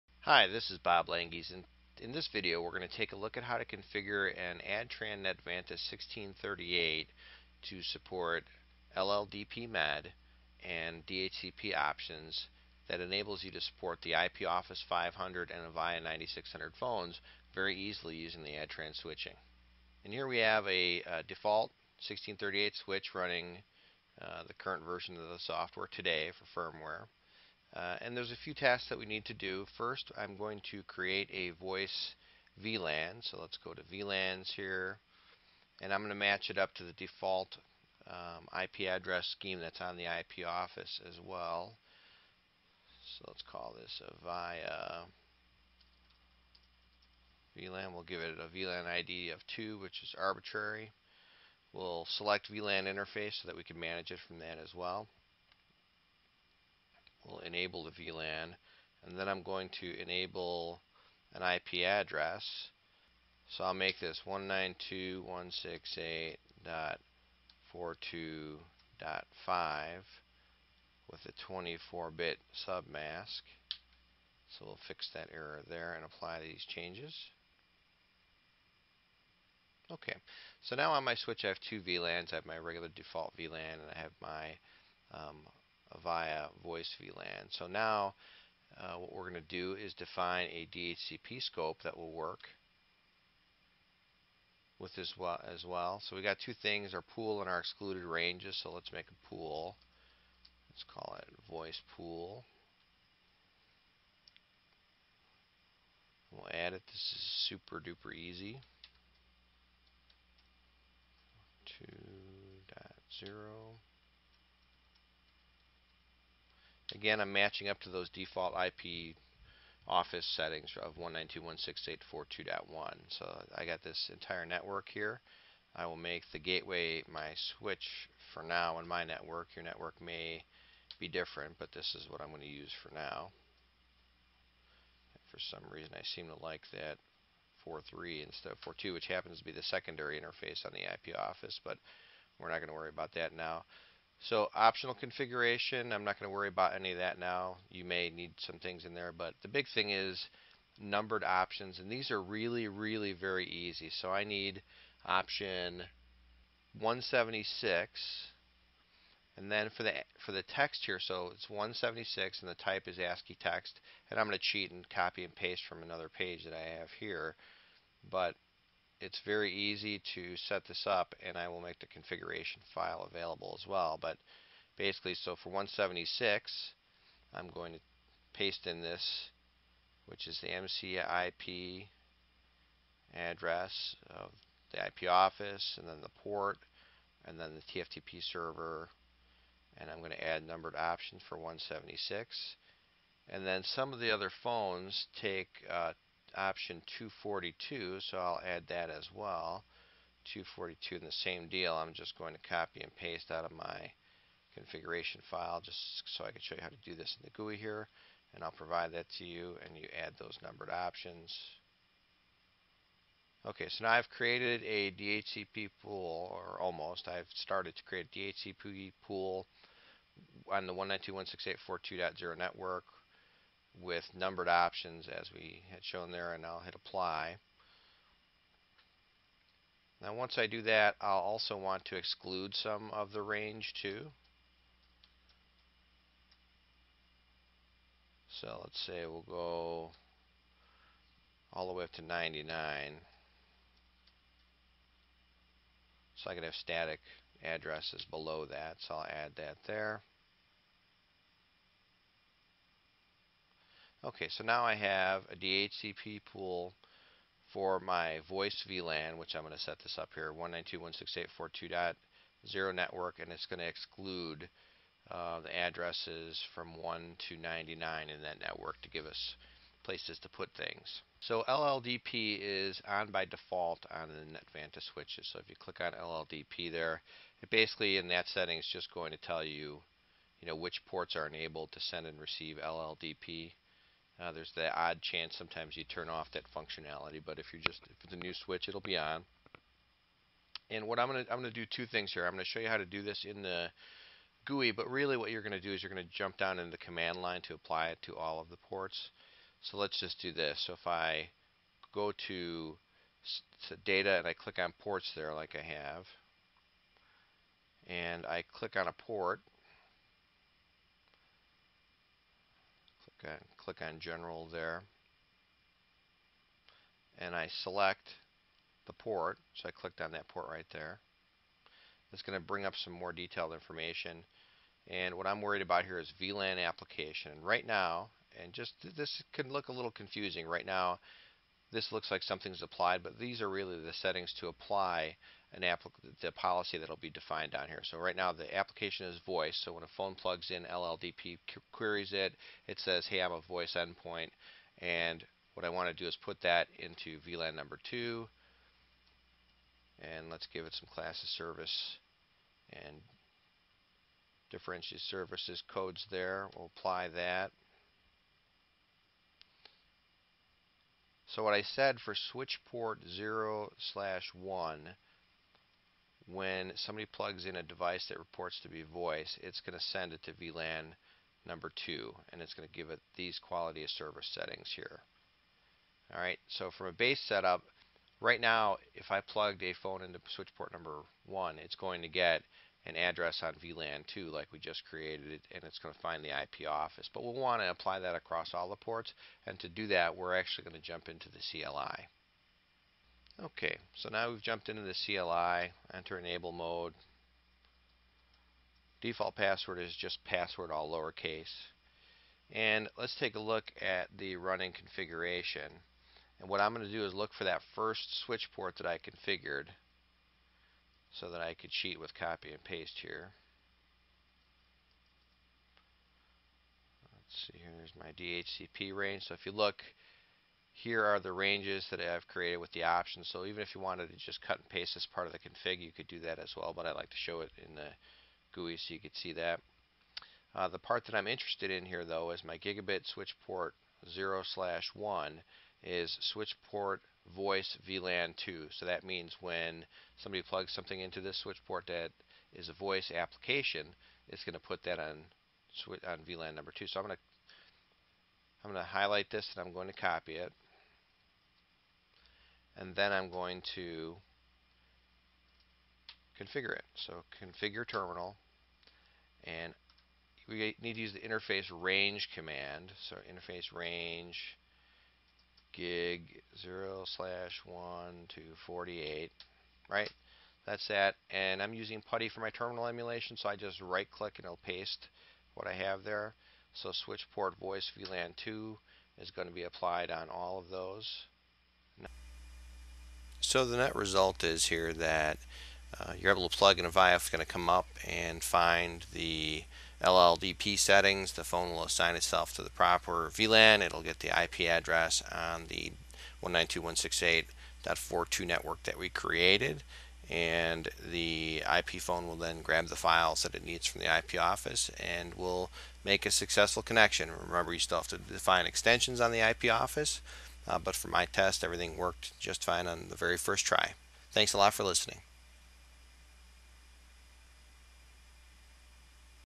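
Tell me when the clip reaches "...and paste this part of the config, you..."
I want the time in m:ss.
7:04.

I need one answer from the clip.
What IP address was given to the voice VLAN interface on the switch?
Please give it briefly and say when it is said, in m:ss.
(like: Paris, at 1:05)
192.168.42.5, at 1:04.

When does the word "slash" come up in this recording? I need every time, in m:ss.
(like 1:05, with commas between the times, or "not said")
6:03, 7:14, 7:47.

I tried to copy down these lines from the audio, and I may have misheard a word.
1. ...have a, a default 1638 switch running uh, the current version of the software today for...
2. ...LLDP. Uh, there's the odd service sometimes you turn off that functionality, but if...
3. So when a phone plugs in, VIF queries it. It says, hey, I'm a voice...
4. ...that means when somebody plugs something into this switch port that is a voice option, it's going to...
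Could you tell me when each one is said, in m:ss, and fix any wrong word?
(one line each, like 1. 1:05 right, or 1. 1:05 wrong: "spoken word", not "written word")
1. 0:20 right
2. 4:42 wrong: "chance", not "service"
3. 5:39 wrong: "LLDP", not "VIF"
4. 7:18 wrong: "application", not "option".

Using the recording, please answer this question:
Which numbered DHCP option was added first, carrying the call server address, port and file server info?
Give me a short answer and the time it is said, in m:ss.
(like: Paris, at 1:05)
176, at 2:35.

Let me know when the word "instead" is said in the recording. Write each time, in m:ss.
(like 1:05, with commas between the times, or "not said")
2:18.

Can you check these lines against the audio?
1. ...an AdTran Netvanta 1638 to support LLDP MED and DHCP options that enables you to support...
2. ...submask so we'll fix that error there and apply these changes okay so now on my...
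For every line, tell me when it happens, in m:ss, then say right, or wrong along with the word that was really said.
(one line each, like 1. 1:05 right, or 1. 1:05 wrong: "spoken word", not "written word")
1. 0:04 right
2. 1:12 right.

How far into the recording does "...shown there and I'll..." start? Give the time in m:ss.
3:45.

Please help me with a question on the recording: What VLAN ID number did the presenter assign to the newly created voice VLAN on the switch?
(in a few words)
2.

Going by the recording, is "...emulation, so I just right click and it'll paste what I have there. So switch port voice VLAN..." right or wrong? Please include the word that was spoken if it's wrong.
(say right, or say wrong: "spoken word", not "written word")
right.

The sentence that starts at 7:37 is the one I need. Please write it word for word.
So configure terminal and we need to use the interface range command.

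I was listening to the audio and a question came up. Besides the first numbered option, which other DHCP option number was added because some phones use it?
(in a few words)
242.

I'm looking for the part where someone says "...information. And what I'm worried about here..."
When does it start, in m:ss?
5:23.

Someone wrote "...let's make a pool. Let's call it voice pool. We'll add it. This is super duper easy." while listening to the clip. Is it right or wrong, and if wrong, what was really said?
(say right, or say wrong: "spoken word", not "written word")
right.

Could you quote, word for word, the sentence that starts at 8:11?
The phone will assign itself to the proper VLAN.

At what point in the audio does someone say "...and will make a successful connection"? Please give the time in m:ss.
8:25.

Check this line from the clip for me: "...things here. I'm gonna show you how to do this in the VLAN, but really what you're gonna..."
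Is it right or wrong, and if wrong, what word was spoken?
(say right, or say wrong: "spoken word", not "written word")
wrong: "GUI", not "VLAN".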